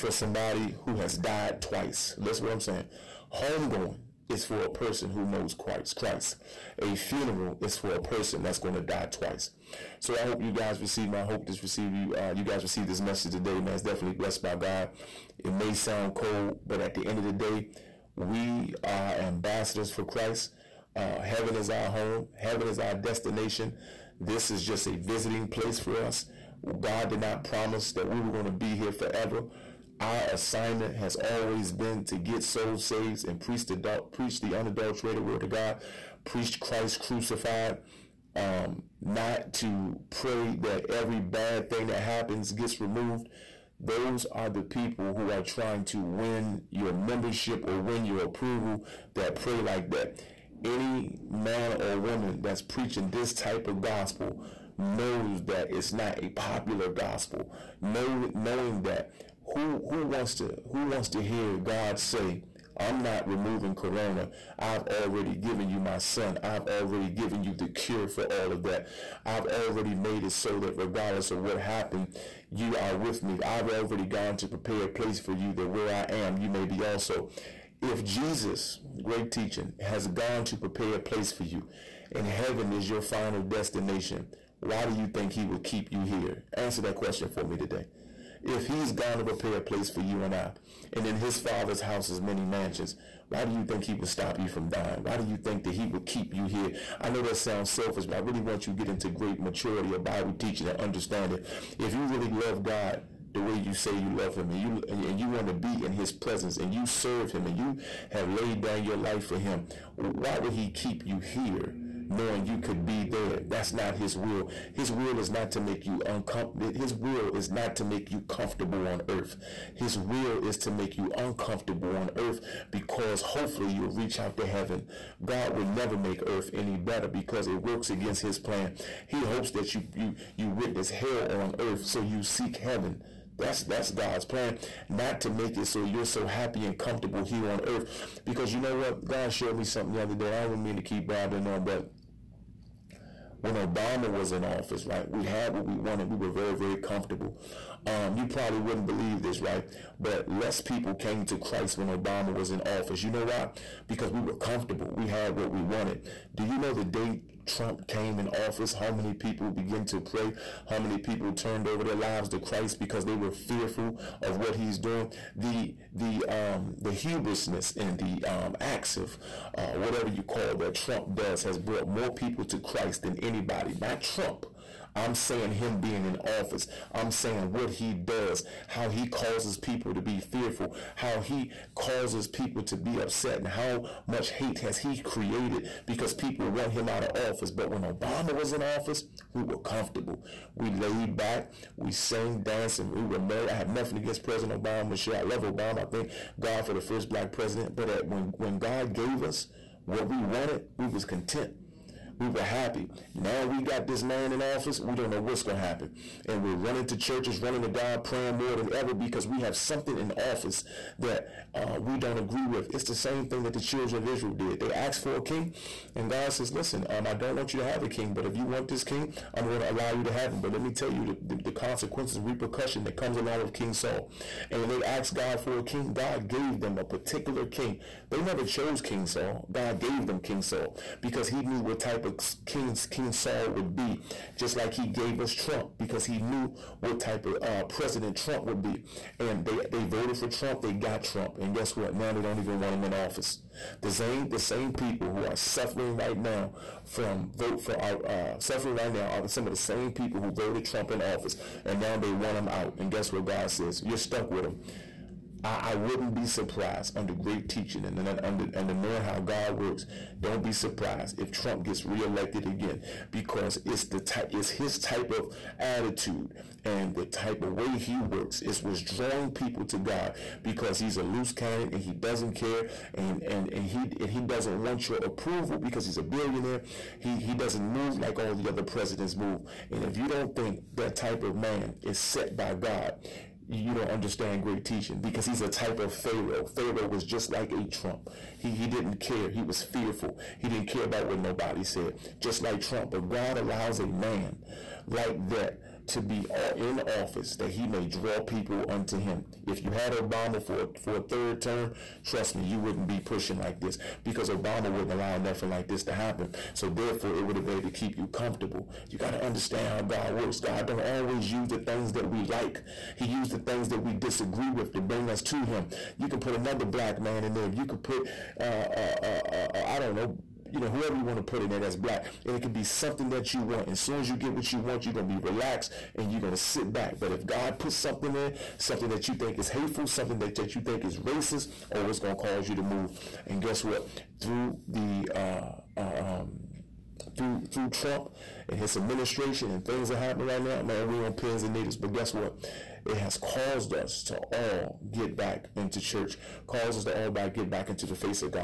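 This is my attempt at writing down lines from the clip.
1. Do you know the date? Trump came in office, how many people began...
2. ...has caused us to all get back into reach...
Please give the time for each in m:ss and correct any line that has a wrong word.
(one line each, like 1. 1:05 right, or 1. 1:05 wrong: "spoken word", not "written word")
1. 2:36 right
2. 5:42 wrong: "church", not "reach".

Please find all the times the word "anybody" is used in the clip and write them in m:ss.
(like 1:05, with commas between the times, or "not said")
2:53.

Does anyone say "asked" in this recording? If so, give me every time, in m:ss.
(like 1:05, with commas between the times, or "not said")
3:34, 3:44.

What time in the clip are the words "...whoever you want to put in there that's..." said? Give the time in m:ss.
5:20.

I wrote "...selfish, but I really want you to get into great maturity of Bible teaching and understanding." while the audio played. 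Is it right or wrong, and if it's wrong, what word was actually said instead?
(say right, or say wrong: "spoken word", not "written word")
right.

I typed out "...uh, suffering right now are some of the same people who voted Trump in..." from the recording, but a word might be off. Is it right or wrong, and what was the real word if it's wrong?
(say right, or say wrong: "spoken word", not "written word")
right.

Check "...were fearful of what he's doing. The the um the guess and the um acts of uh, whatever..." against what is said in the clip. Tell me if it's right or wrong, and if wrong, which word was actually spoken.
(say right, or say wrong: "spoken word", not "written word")
wrong: "hubrisness", not "guess".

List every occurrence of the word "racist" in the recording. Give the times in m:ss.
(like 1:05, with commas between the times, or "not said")
5:30.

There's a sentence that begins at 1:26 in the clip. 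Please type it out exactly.
Answer that question for me today.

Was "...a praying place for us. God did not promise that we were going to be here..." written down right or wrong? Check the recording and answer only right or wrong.
wrong.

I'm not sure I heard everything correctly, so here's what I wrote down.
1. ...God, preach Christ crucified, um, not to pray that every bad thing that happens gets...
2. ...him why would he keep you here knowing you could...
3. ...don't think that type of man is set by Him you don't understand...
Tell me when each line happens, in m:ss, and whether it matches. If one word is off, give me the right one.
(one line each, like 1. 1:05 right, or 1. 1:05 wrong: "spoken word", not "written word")
1. 0:35 right
2. 1:49 right
3. 4:40 wrong: "God", not "Him".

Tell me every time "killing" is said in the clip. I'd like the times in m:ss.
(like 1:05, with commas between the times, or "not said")
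not said.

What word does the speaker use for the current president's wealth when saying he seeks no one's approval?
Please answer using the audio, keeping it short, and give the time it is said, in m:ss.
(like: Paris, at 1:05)
billionaire, at 4:36.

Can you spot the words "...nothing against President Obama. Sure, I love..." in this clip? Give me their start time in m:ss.
3:13.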